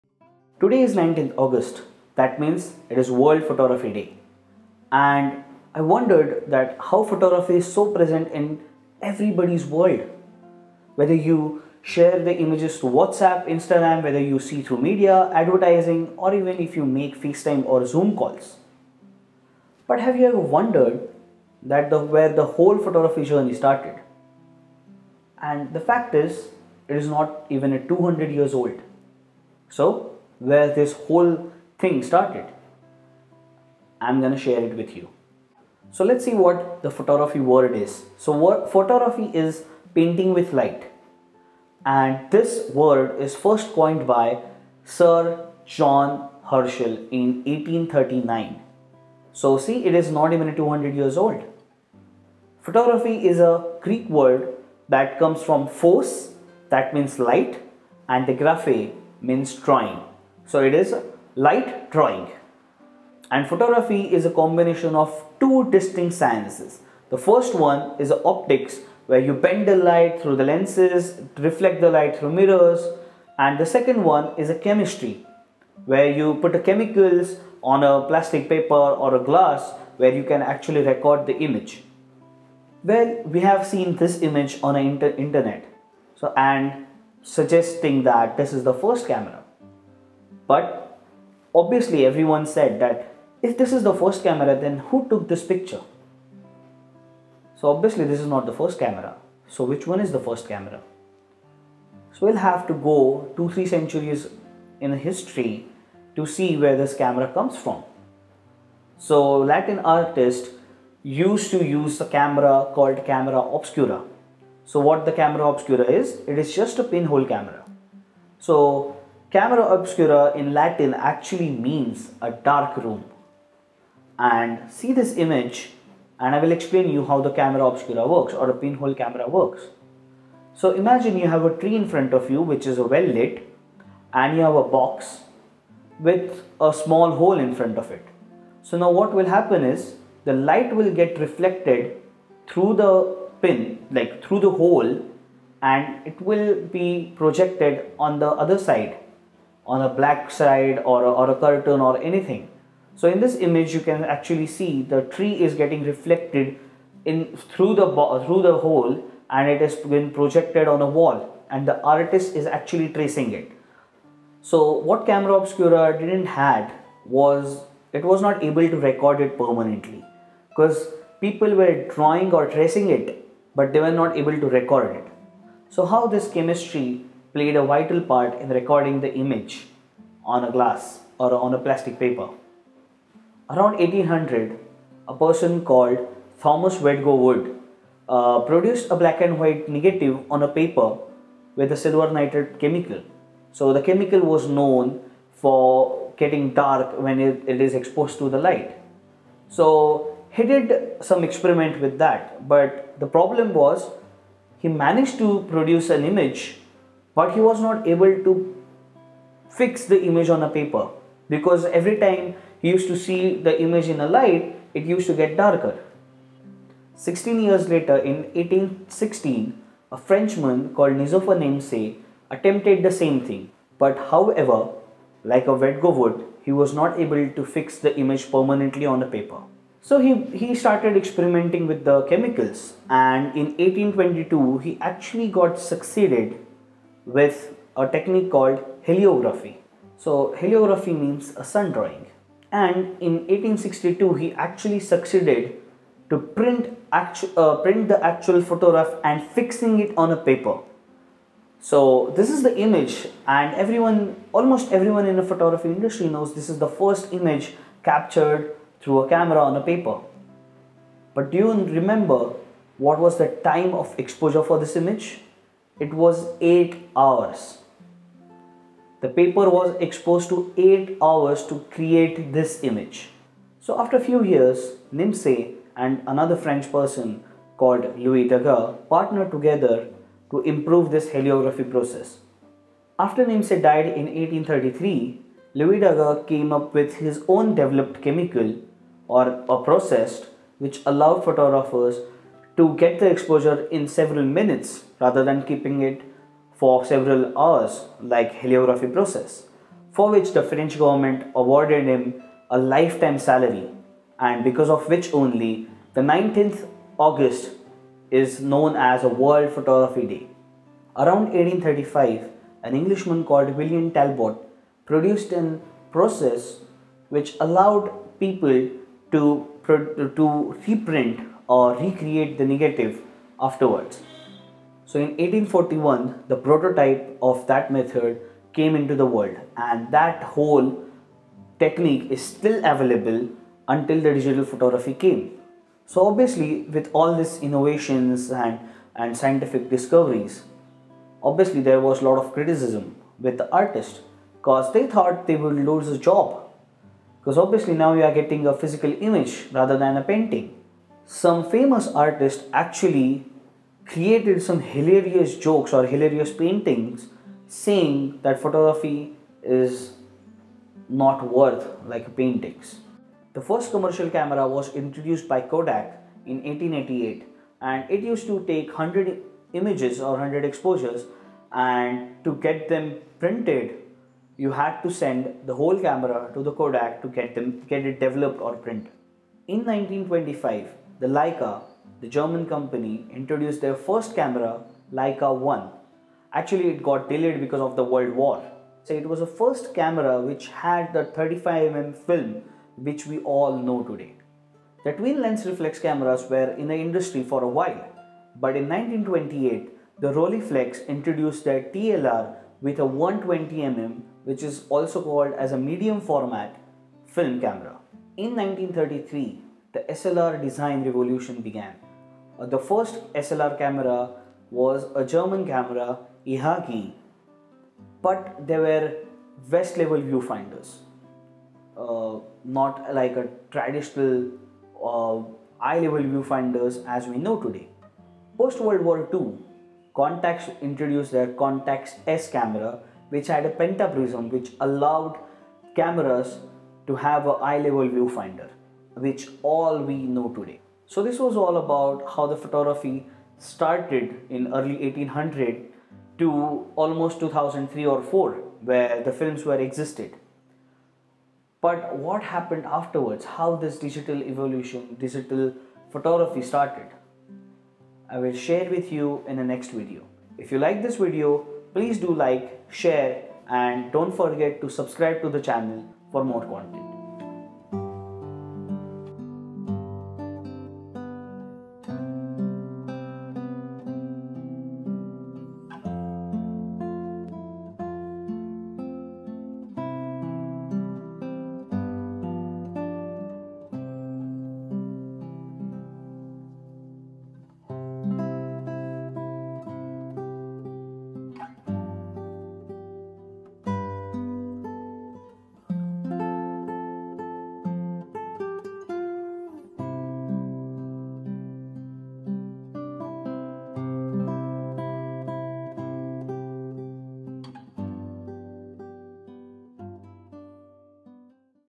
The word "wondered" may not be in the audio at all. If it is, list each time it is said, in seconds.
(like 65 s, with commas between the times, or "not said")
5 s, 20 s.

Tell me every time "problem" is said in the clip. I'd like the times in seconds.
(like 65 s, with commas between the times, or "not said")
203 s.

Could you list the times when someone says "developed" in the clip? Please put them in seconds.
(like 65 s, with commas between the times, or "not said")
287 s, 377 s.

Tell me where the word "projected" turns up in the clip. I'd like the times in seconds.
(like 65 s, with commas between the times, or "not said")
147 s, 160 s.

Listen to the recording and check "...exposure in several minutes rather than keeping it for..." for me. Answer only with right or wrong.
right.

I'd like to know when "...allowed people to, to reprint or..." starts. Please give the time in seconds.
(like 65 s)
317 s.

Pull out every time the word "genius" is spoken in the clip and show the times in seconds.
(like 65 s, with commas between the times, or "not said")
not said.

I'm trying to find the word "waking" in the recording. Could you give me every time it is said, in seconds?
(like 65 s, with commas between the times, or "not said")
not said.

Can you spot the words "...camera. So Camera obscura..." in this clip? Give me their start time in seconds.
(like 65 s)
117 s.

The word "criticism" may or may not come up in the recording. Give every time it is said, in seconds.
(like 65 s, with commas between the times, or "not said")
342 s.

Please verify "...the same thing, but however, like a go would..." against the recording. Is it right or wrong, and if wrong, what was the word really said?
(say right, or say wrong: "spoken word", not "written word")
right.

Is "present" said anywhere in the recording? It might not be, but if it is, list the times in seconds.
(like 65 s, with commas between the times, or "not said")
7 s.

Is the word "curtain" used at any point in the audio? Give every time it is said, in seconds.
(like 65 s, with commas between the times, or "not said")
151 s.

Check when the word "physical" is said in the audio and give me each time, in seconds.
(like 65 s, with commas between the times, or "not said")
348 s.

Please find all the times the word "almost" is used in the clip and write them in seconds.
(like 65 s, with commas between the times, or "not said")
254 s, 446 s.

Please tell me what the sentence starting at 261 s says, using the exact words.
But do you remember what was the time of exposure for this image?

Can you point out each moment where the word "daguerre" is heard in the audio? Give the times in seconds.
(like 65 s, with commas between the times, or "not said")
278 s, 285 s.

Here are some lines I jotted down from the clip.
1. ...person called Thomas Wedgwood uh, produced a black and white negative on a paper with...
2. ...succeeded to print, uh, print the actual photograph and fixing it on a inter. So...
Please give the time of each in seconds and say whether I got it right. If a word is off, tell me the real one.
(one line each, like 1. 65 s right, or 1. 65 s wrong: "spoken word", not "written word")
1. 185 s right
2. 244 s wrong: "paper", not "inter".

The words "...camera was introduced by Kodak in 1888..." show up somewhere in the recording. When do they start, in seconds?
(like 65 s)
364 s.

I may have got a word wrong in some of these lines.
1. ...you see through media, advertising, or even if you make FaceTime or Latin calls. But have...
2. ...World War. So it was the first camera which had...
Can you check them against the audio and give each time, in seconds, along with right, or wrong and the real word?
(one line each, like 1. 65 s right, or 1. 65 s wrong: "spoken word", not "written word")
1. 14 s wrong: "Zoom", not "Latin"
2. 387 s right.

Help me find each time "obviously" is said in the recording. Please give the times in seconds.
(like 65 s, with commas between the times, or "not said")
91 s, 97 s, 336 s, 341 s, 347 s.